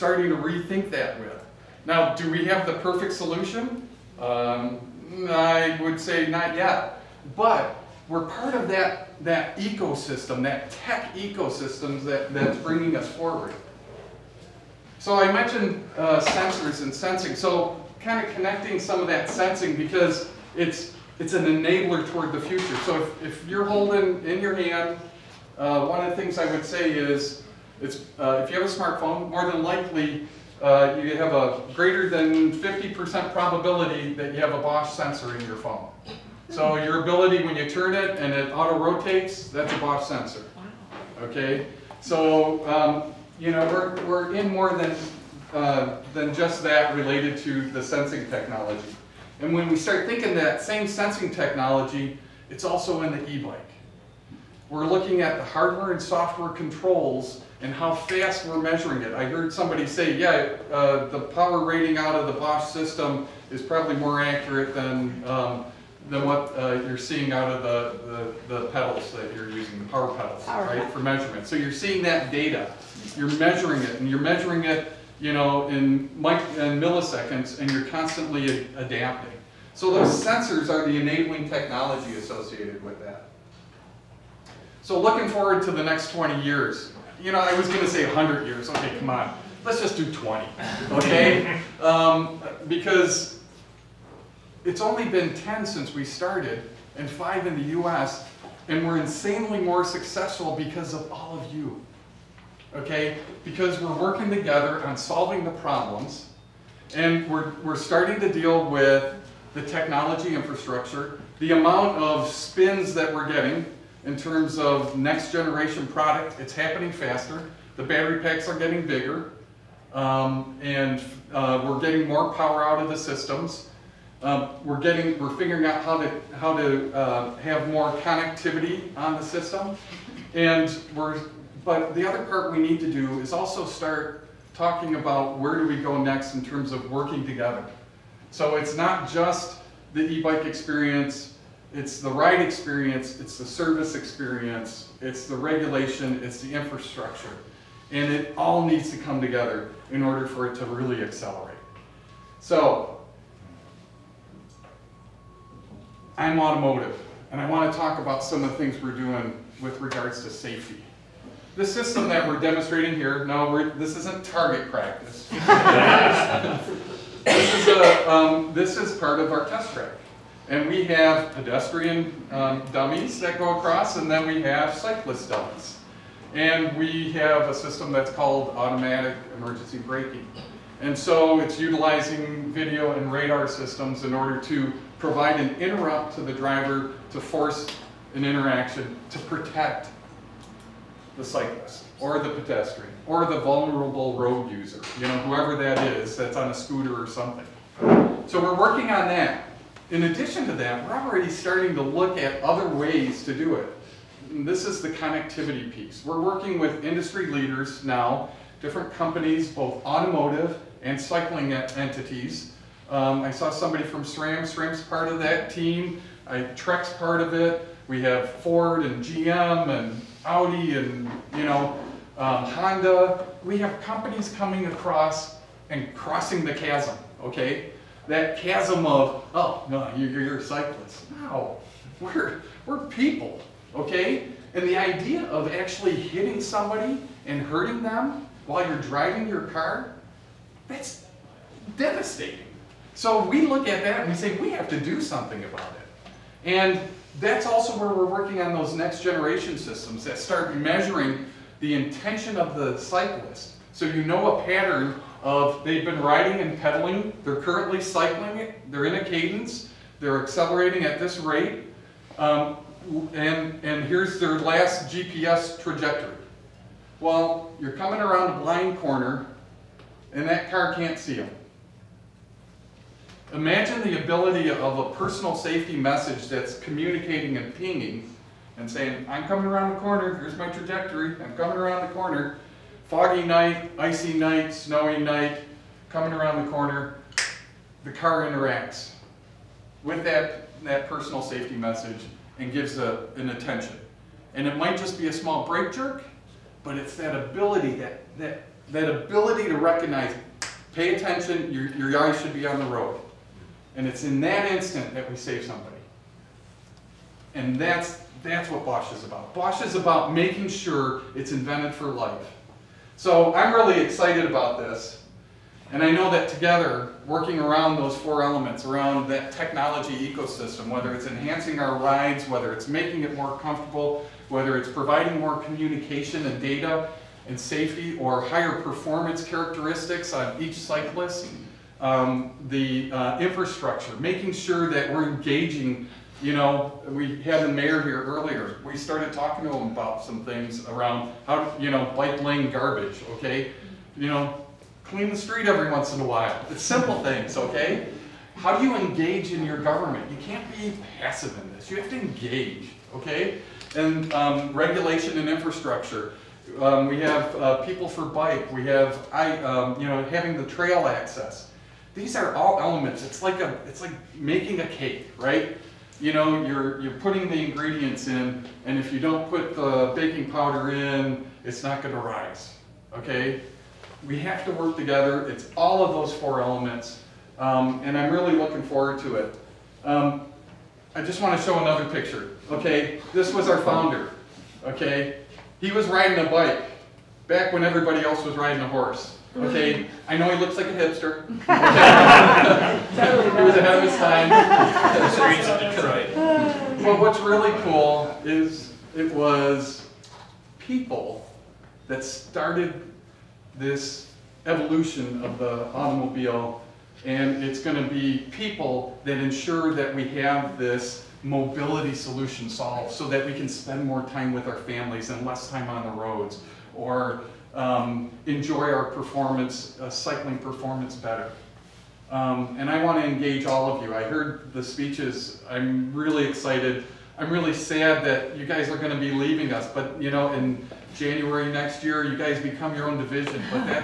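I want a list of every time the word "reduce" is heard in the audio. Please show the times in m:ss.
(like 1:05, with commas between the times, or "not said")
not said.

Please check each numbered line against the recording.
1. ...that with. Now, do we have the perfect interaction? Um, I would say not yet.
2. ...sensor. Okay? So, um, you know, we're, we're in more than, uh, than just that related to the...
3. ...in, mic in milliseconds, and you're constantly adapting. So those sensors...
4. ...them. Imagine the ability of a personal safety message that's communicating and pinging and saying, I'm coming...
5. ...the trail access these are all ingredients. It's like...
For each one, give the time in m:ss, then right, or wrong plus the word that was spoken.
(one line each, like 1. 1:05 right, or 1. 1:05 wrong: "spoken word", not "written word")
1. 0:00 wrong: "solution", not "interaction"
2. 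0:40 right
3. 1:15 right
4. 4:31 right
5. 6:00 wrong: "elements", not "ingredients".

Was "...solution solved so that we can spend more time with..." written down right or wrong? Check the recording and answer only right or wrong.
right.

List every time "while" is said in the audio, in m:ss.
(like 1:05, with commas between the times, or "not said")
3:58, 5:46.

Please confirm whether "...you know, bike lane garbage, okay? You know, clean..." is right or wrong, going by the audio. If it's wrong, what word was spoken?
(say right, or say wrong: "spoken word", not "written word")
right.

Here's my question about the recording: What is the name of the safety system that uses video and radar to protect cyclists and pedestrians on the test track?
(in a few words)
automatic emergency braking.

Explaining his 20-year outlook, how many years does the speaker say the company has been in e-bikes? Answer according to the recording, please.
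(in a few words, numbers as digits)
10.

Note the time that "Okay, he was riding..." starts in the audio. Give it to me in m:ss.
6:24.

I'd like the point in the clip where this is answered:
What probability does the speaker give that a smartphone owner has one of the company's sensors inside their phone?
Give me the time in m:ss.
0:31.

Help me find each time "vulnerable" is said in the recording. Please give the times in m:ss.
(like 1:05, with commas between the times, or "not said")
3:13.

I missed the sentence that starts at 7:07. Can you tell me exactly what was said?
I'm really sad that you guys are going to be leaving us.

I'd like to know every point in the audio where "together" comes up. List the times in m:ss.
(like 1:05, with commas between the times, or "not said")
1:44, 2:17, 2:29, 5:16, 6:14.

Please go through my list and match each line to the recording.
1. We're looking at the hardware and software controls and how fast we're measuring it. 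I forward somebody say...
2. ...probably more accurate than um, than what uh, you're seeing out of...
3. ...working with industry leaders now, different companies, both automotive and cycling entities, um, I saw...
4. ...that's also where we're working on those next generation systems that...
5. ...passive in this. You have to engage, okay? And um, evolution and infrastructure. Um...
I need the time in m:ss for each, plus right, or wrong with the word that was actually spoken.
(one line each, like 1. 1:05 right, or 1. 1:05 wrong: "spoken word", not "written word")
1. 0:54 wrong: "heard", not "forward"
2. 1:03 right
3. 3:26 right
4. 4:07 right
5. 5:50 wrong: "regulation", not "evolution".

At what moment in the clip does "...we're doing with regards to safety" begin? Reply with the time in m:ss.
2:38.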